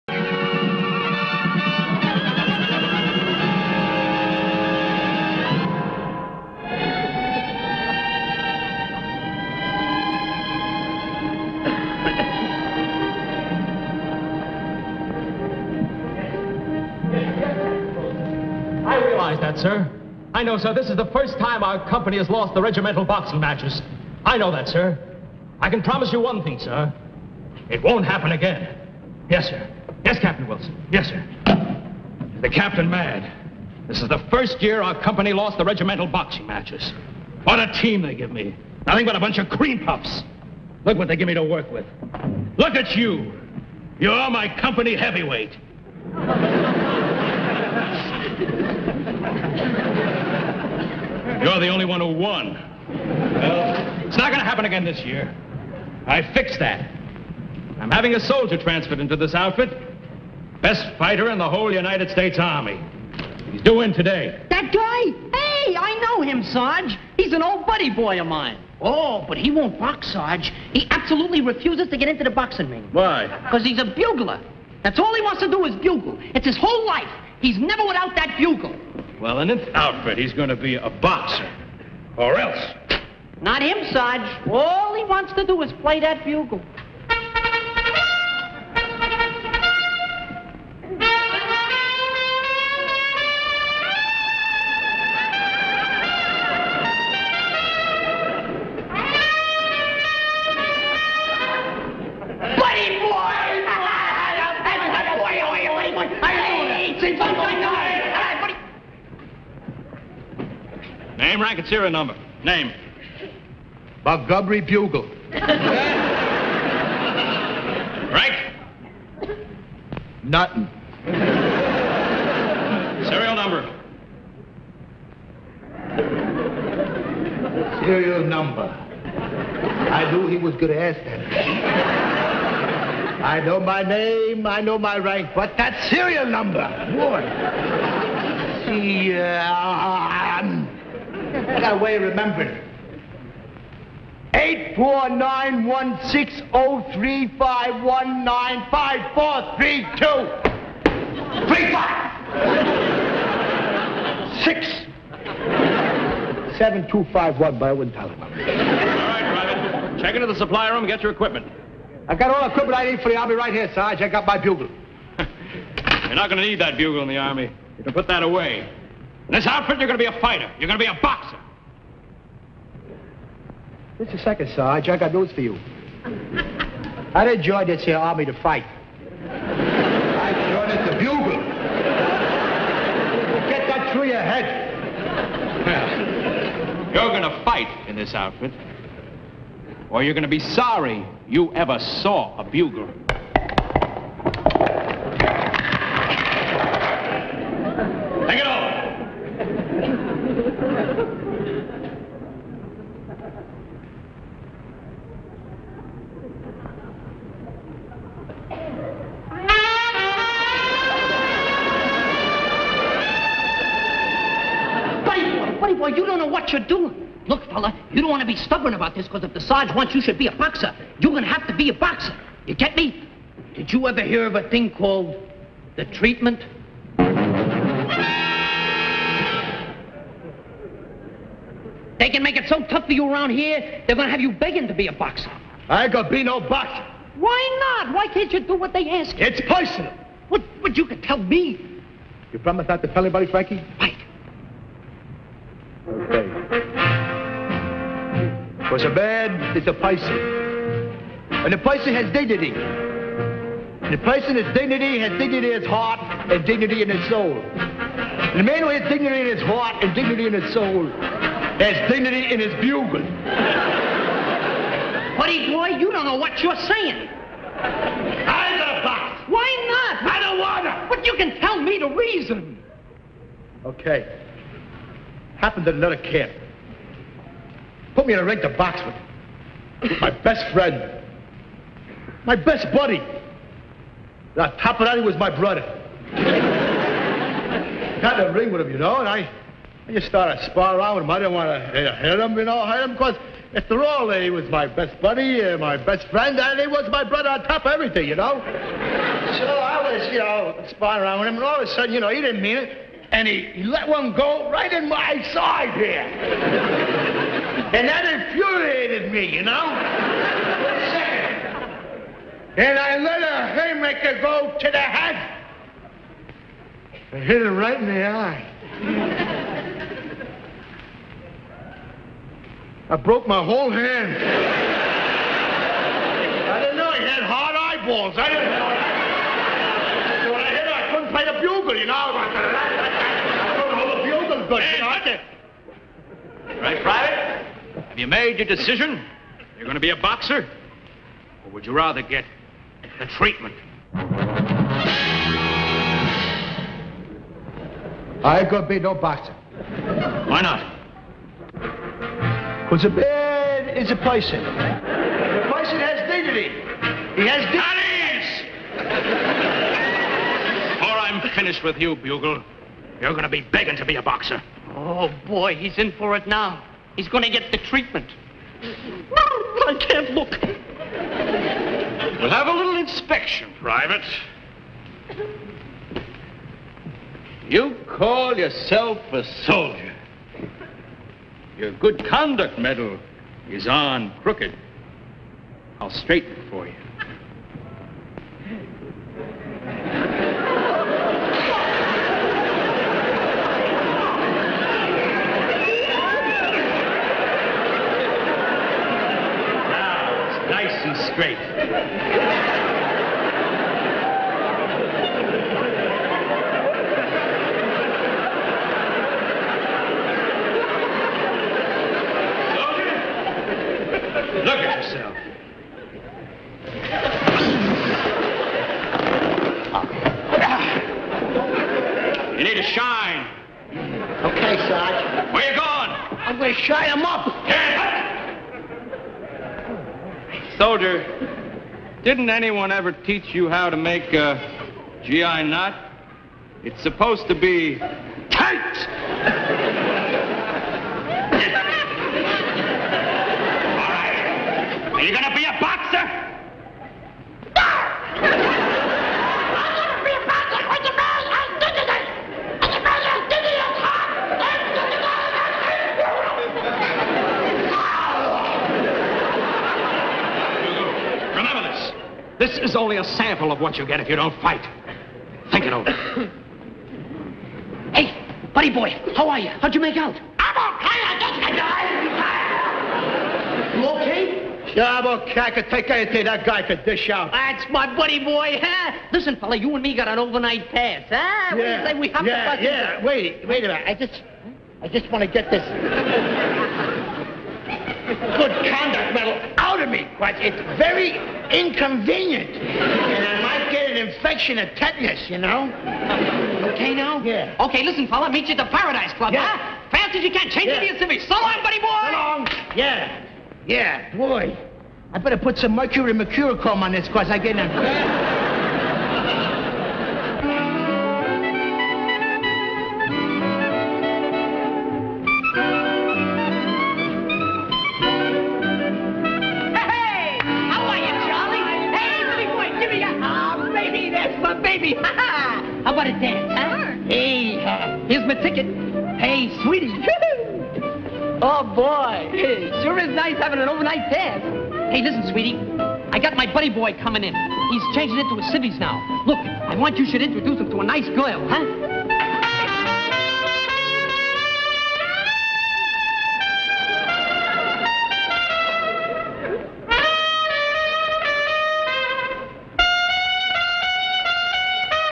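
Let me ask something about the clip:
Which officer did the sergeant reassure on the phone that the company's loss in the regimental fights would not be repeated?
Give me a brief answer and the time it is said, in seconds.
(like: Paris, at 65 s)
Captain Wilson, at 30 s.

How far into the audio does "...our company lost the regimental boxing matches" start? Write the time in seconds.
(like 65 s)
34 s.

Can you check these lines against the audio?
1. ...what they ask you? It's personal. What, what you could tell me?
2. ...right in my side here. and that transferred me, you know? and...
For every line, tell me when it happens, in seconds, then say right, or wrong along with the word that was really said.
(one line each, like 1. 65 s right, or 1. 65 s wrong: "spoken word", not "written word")
1. 238 s right
2. 304 s wrong: "infuriated", not "transferred".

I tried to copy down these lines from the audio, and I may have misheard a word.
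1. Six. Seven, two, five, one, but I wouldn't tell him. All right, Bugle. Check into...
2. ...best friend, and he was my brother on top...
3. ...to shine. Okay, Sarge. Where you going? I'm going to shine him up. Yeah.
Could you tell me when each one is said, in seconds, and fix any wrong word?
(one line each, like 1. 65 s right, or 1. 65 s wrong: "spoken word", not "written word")
1. 154 s wrong: "Private", not "Bugle"
2. 295 s right
3. 422 s right.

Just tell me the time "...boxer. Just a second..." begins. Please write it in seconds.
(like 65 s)
171 s.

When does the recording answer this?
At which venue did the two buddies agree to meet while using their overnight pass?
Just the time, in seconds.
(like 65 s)
498 s.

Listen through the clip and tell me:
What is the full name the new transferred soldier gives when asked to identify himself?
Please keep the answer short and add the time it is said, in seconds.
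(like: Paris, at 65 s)
Montgomery Bugle, at 114 s.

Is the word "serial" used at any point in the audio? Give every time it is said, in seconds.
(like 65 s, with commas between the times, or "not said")
111 s, 123 s, 127 s, 135 s.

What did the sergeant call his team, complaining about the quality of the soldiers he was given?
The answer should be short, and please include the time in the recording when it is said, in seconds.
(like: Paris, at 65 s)
cream puffs, at 39 s.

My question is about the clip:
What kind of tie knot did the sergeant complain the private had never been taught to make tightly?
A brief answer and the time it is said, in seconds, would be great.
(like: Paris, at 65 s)
GI knot, at 435 s.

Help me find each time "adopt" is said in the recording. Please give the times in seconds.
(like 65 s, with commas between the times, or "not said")
not said.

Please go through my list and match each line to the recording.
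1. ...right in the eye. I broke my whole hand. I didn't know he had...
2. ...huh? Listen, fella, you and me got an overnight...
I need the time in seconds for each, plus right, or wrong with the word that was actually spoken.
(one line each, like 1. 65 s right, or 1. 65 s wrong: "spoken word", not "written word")
1. 317 s right
2. 478 s right.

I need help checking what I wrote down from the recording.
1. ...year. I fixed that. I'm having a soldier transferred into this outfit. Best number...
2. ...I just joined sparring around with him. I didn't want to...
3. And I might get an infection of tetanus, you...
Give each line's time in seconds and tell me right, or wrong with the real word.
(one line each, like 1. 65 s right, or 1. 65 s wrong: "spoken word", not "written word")
1. 55 s wrong: "fighter", not "number"
2. 289 s wrong: "started", not "joined"
3. 492 s right.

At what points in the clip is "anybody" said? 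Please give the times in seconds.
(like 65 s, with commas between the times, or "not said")
243 s.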